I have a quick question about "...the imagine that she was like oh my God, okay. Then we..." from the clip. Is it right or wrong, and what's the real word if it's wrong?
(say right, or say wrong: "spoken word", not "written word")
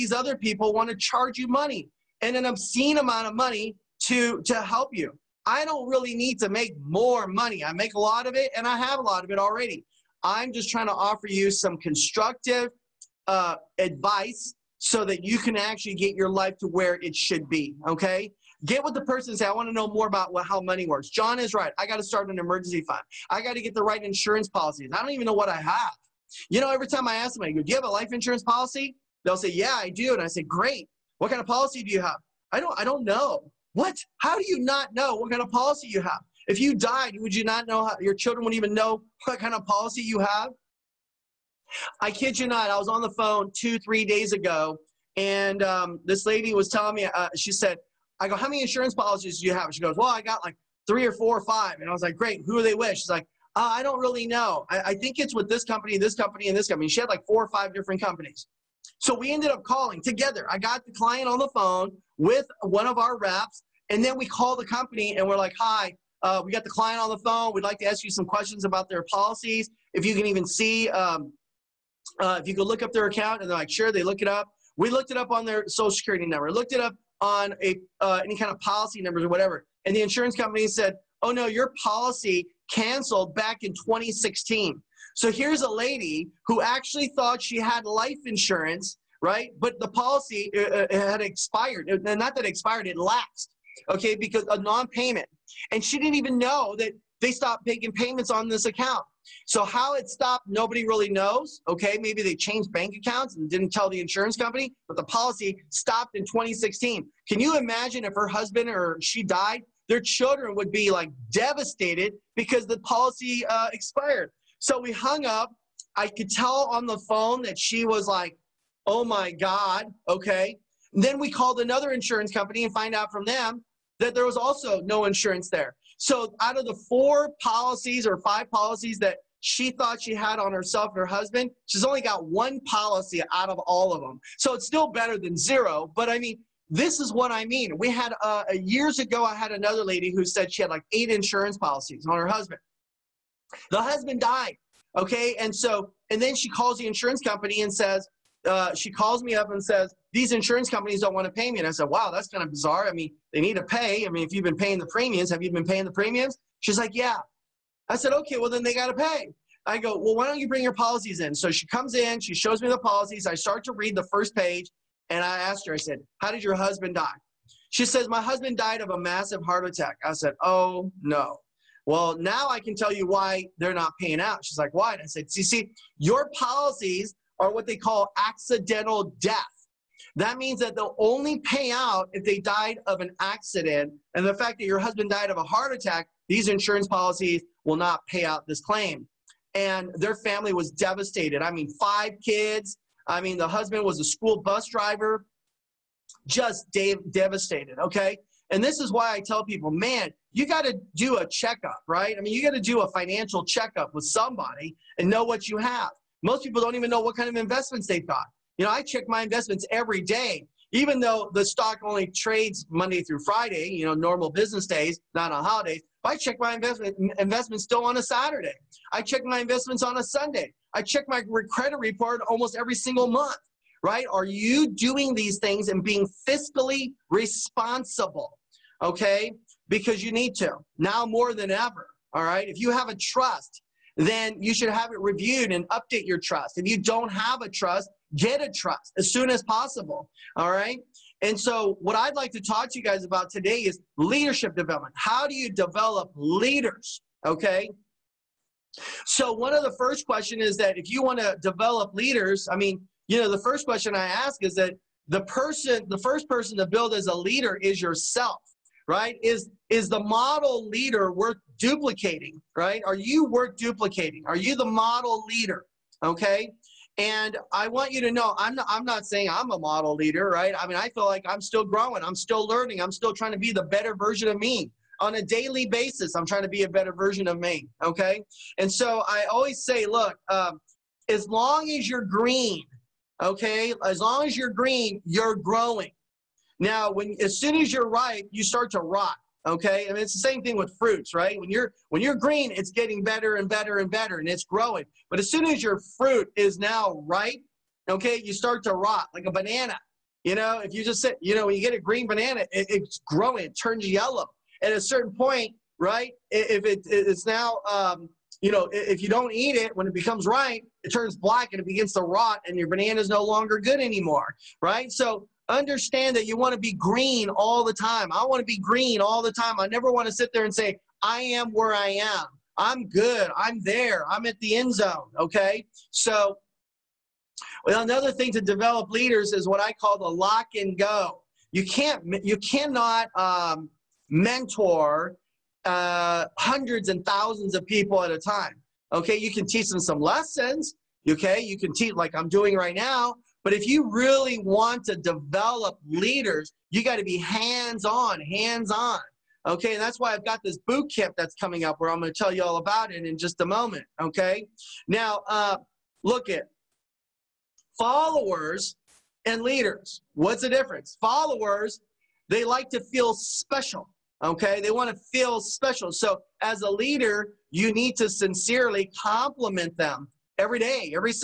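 wrong: "phone", not "imagine".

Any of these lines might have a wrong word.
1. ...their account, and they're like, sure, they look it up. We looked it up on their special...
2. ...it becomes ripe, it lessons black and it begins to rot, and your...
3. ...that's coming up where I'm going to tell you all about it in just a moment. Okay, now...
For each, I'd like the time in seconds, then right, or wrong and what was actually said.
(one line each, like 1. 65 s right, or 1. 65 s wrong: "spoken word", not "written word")
1. 72 s wrong: "social", not "special"
2. 309 s wrong: "turns", not "lessons"
3. 351 s right.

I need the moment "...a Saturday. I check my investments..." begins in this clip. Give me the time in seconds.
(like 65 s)
217 s.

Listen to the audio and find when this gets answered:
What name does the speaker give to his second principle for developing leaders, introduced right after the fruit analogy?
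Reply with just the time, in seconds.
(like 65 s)
330 s.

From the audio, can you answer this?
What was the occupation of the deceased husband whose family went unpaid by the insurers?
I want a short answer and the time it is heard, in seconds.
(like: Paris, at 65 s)
school bus driver, at 194 s.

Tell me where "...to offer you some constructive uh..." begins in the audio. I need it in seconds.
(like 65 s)
10 s.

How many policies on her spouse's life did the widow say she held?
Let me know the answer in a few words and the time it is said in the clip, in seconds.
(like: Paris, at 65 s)
8, at 140 s.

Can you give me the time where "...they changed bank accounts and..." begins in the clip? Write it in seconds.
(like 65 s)
102 s.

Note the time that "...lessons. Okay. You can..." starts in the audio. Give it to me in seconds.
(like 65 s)
339 s.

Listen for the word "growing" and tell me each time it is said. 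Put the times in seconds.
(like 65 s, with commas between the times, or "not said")
271 s, 285 s, 294 s, 303 s.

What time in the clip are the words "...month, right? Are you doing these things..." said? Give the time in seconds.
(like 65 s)
223 s.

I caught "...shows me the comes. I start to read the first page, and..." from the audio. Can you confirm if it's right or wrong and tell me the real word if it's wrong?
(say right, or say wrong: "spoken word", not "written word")
wrong: "policies", not "comes".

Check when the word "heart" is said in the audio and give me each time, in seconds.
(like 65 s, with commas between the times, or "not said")
169 s, 185 s.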